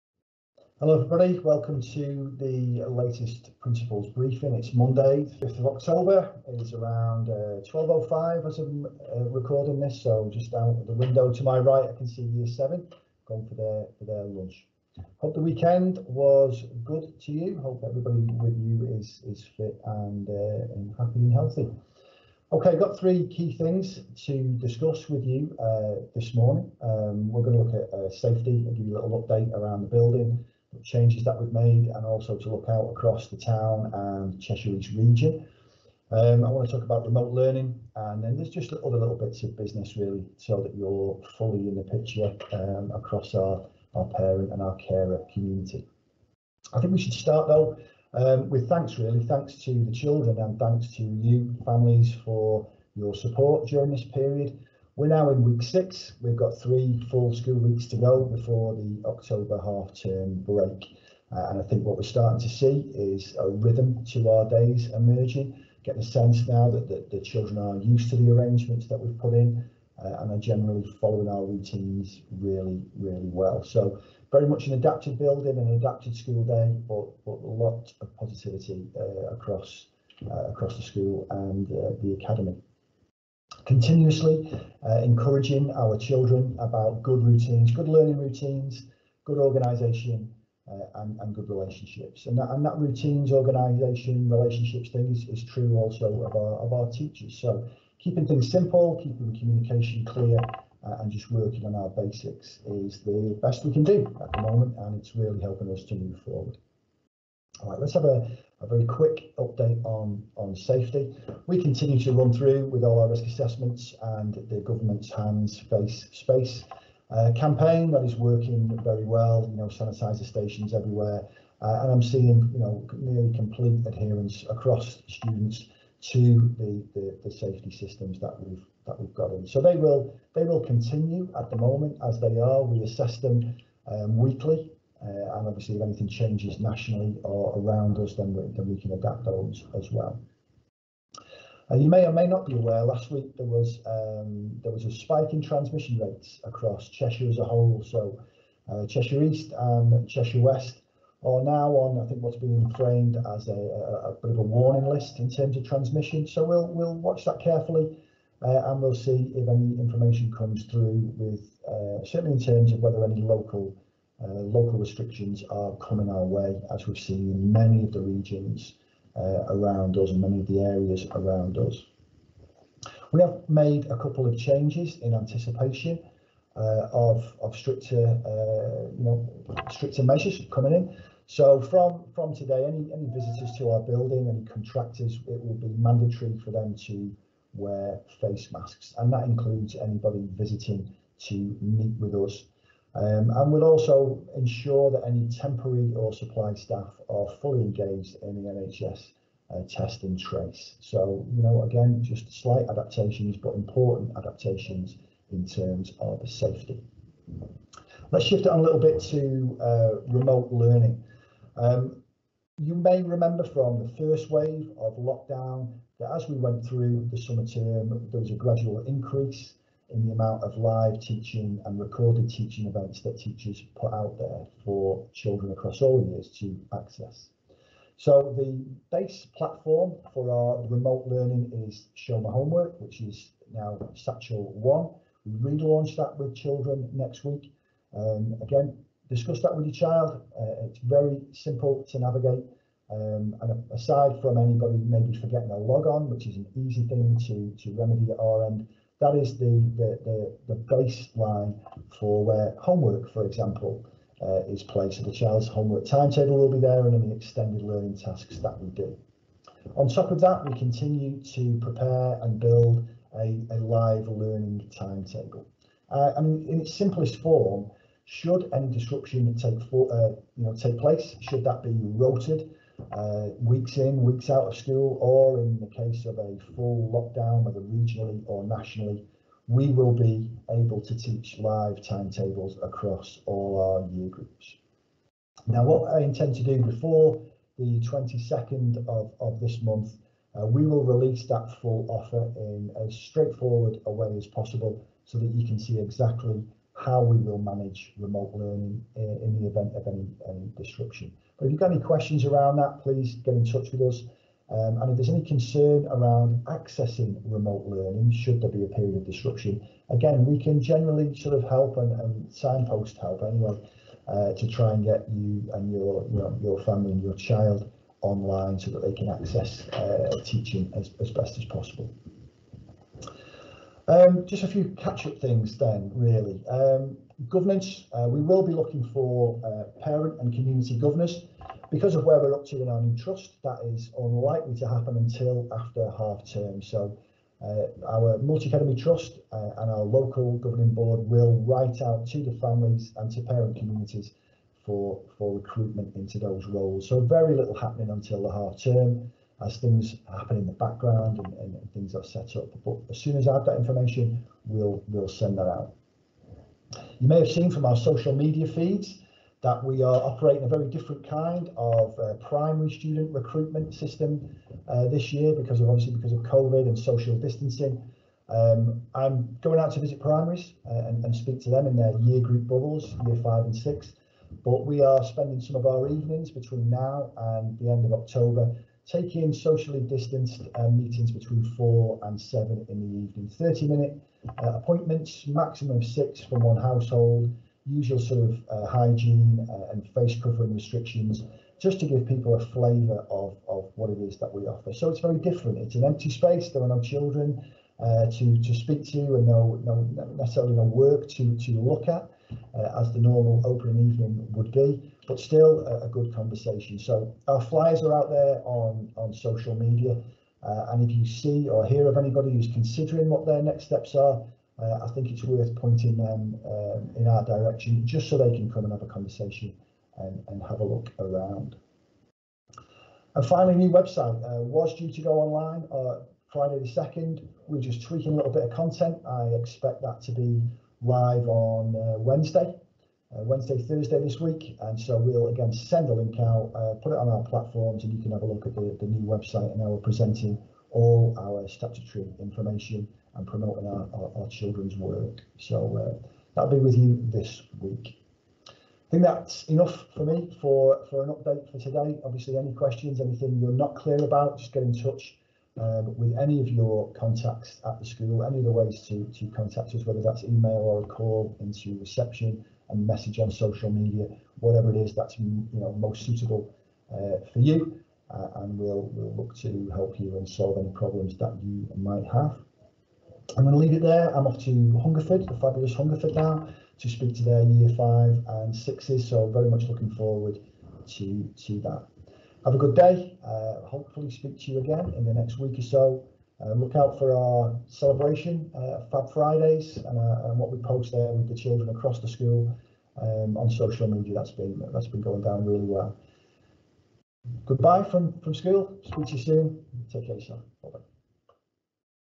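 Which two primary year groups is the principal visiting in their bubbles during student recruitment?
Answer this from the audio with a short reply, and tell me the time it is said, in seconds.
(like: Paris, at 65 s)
Year 5 and 6, at 373 s.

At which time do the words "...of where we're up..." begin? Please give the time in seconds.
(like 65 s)
331 s.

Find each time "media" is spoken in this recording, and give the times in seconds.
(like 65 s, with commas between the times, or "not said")
358 s, 409 s, 463 s, 493 s.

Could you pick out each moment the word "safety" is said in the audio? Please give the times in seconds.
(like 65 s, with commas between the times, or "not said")
28 s, 110 s, 127 s, 206 s.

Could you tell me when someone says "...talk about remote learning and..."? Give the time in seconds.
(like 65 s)
36 s.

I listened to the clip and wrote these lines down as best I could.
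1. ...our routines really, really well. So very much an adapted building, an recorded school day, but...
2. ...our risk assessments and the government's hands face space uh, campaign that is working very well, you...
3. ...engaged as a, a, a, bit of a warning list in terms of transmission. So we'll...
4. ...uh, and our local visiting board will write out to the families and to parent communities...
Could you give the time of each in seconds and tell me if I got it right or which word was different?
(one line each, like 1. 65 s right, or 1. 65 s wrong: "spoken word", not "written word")
1. 71 s wrong: "adapted", not "recorded"
2. 112 s right
3. 152 s wrong: "framed", not "engaged"
4. 339 s wrong: "governing", not "visiting".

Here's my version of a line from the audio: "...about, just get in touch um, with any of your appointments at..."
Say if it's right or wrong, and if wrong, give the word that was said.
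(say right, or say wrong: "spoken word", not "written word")
wrong: "contacts", not "appointments".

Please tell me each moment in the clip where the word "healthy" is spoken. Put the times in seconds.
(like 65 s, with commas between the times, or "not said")
21 s.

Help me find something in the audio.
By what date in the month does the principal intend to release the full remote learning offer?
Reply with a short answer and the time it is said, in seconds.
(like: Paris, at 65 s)
22nd, at 287 s.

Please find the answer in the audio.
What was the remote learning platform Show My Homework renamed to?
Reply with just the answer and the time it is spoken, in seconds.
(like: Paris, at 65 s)
Satchel 1, at 233 s.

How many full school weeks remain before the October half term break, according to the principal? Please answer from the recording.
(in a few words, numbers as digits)
3.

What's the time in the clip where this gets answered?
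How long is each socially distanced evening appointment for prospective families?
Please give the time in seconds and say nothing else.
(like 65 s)
383 s.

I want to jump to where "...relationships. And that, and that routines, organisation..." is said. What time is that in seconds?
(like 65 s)
91 s.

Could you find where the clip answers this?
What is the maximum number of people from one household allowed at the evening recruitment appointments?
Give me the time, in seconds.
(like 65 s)
385 s.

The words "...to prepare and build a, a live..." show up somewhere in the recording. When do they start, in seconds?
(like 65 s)
261 s.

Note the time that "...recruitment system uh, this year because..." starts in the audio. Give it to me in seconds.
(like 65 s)
363 s.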